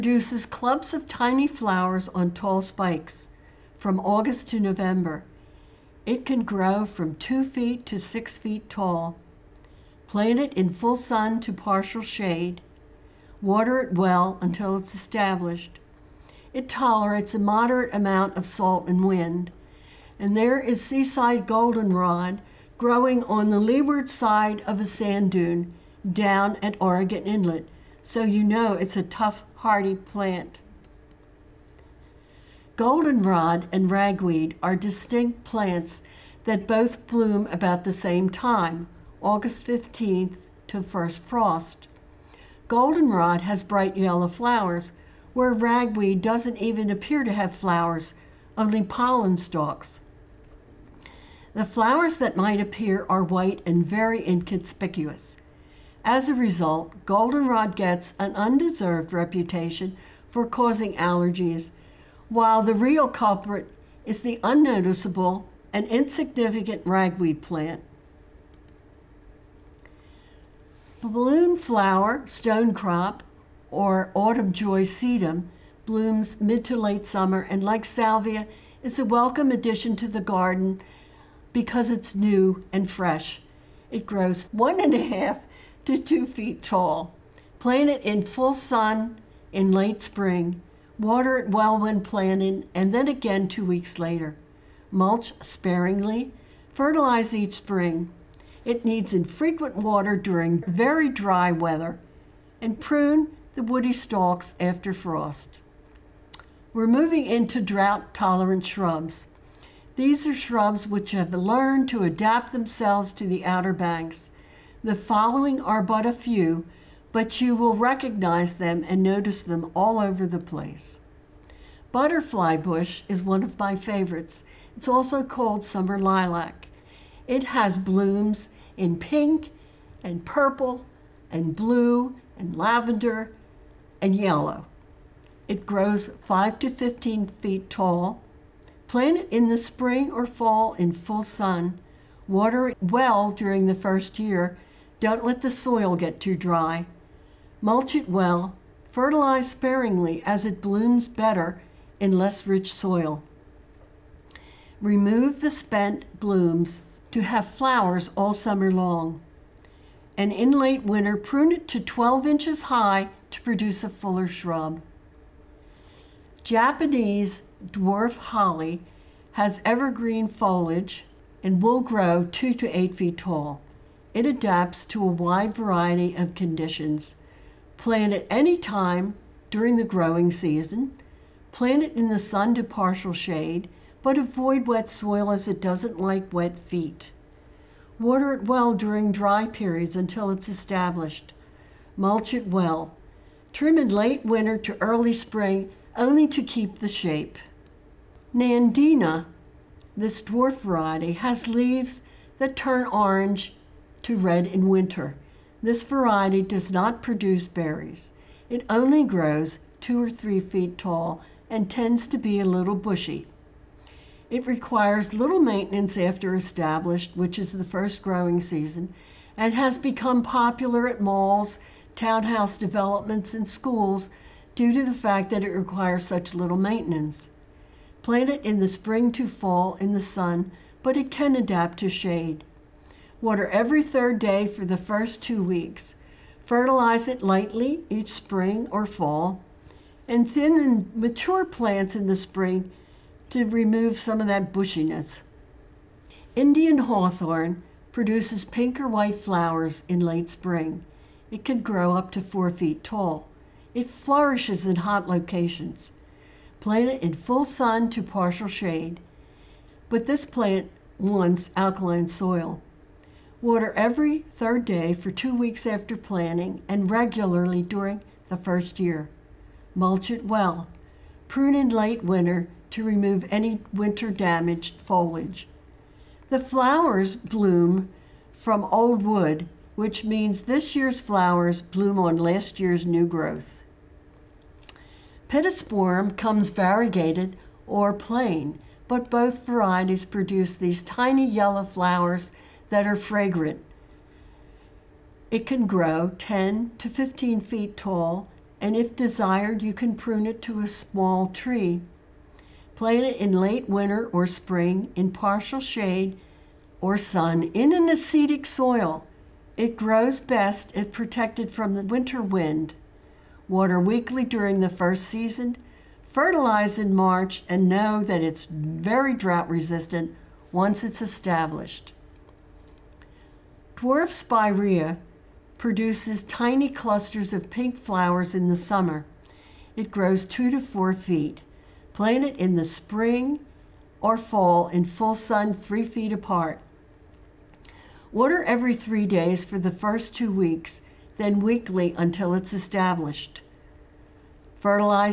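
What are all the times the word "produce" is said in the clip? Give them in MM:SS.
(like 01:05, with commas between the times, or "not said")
02:43, 03:27, 04:07, 04:50, 05:25.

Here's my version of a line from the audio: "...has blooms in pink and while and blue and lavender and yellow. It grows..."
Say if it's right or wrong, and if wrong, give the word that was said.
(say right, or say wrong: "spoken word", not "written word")
wrong: "purple", not "while".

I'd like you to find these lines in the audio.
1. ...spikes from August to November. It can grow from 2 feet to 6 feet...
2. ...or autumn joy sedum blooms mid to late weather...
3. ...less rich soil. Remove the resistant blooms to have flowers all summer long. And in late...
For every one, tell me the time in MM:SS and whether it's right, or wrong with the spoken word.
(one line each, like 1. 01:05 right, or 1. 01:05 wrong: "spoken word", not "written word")
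1. 00:02 right
2. 01:13 wrong: "summer", not "weather"
3. 02:32 wrong: "spent", not "resistant".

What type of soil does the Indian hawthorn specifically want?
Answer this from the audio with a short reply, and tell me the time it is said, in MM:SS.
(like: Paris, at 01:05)
Alkaline soil, at 04:21.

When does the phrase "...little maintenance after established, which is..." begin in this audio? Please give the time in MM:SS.
03:35.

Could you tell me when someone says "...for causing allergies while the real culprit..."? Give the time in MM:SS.
01:00.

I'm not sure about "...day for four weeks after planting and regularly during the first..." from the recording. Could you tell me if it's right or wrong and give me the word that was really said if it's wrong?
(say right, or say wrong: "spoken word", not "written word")
wrong: "two", not "four".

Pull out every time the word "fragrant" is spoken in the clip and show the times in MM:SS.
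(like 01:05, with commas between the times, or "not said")
04:52.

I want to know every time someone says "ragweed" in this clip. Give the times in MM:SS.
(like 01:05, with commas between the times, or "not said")
00:33, 00:45, 01:06.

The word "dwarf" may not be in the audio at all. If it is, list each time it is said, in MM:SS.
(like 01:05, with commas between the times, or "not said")
02:47, 03:20, 05:23.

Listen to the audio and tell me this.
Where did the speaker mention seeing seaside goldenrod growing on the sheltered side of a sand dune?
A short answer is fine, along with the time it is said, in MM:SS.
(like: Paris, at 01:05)
Oregon Inlet, at 00:26.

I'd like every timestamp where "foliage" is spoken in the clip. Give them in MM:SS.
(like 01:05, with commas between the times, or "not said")
02:50, 04:34.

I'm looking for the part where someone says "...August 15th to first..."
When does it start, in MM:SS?
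00:39.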